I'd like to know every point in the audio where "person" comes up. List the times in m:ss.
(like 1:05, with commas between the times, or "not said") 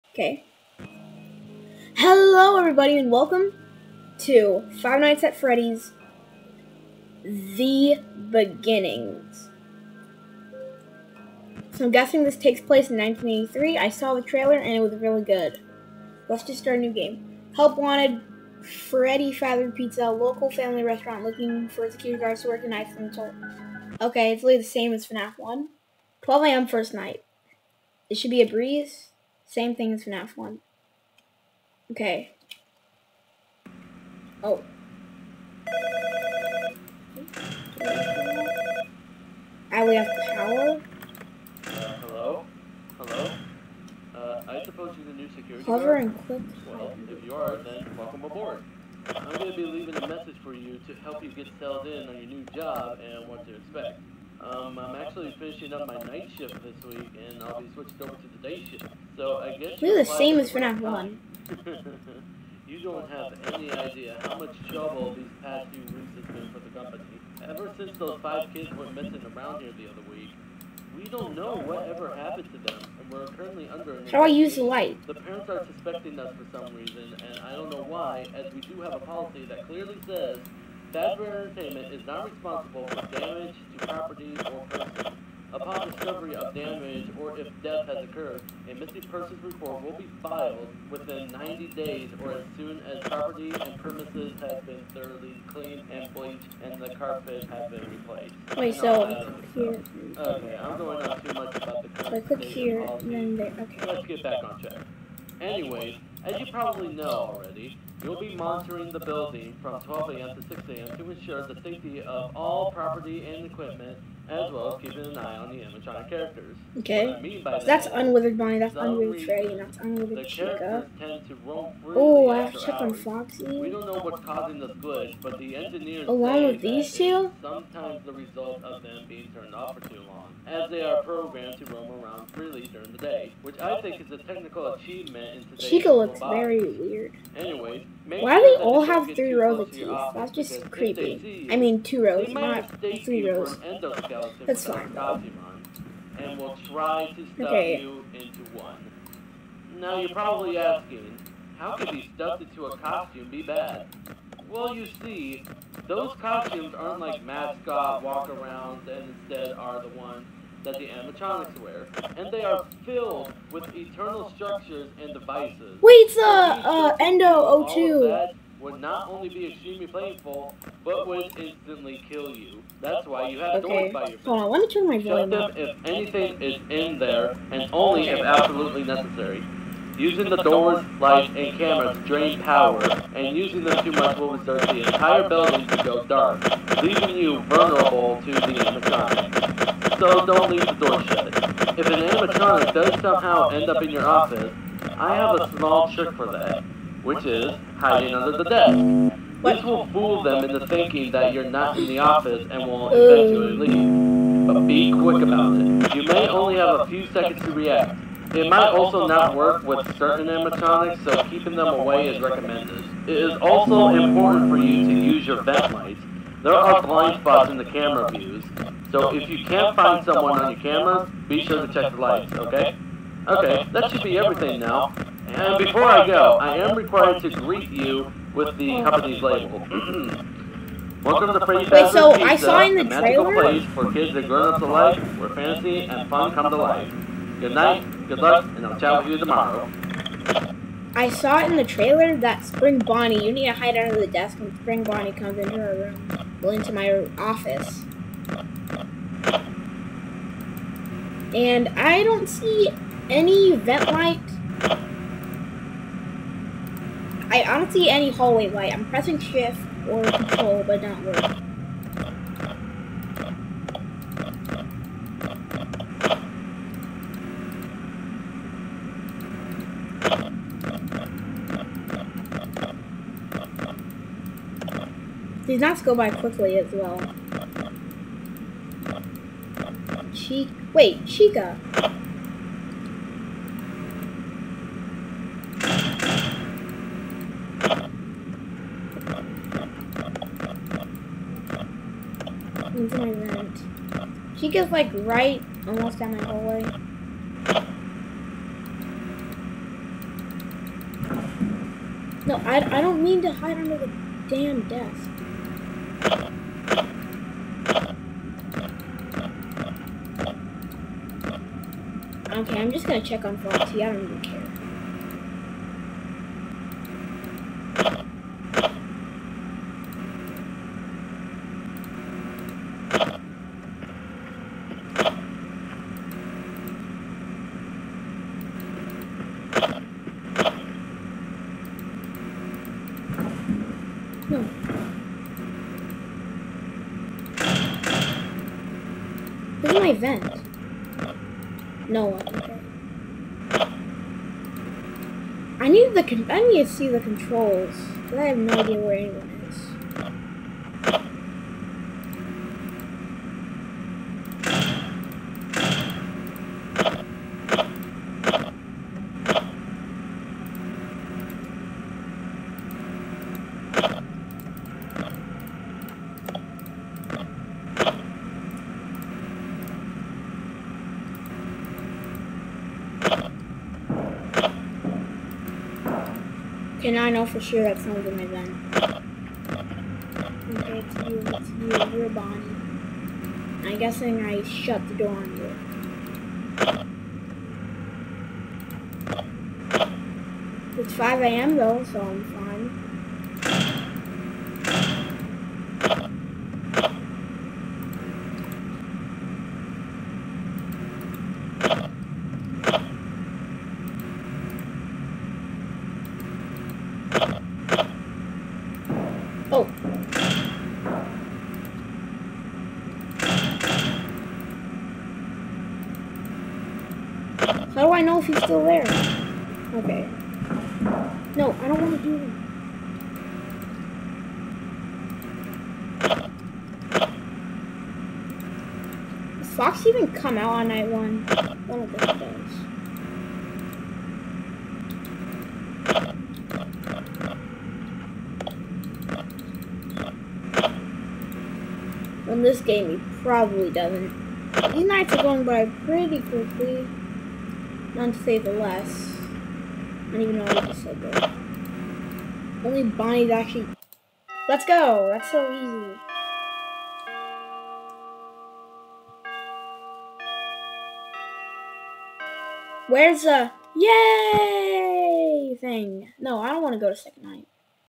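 1:24, 1:29.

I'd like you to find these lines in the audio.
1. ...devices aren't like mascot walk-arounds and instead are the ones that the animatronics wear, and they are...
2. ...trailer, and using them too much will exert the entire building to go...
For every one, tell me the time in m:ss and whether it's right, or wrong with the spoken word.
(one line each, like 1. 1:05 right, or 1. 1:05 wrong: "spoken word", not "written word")
1. 2:36 wrong: "costumes", not "devices"
2. 3:02 wrong: "power", not "trailer".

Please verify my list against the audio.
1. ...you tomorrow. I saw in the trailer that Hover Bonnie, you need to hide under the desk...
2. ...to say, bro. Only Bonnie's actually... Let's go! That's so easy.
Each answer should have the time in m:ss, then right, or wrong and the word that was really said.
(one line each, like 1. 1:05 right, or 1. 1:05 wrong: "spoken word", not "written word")
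1. 3:59 wrong: "Spring", not "Hover"
2. 7:30 right.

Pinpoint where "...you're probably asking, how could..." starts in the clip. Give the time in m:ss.
2:29.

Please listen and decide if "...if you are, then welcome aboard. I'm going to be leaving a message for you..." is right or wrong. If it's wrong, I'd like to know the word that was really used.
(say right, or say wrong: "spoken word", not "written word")
right.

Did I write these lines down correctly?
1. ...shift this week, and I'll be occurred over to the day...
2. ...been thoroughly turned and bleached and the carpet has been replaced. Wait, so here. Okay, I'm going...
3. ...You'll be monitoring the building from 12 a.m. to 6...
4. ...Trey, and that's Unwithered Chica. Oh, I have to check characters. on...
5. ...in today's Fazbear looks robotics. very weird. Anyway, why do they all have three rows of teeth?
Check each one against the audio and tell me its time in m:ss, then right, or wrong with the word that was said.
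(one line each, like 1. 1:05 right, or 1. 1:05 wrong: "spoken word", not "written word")
1. 0:56 wrong: "switched", not "occurred"
2. 1:34 wrong: "cleaned", not "turned"
3. 1:48 right
4. 1:59 wrong: "hours", not "characters"
5. 2:15 wrong: "Chica", not "Fazbear".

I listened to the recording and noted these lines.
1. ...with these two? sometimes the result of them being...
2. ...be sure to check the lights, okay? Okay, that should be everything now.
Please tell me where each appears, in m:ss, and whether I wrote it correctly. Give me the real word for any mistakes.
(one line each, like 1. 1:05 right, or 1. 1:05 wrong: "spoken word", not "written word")
1. 2:06 right
2. 3:41 right.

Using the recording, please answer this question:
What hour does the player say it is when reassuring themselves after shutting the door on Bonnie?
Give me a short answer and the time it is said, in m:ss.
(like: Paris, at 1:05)
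5 a.m., at 6:30.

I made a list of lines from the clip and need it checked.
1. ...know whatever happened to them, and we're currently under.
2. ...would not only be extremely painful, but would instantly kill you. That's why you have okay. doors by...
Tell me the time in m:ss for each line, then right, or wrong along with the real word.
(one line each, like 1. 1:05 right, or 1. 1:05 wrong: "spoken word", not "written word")
1. 1:11 right
2. 2:48 right.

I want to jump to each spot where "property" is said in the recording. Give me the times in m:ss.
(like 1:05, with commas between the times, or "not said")
1:23, 1:33, 1:52.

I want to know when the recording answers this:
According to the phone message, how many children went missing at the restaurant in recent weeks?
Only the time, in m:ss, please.
1:08.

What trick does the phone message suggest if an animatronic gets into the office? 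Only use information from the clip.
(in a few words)
Hiding under the desk.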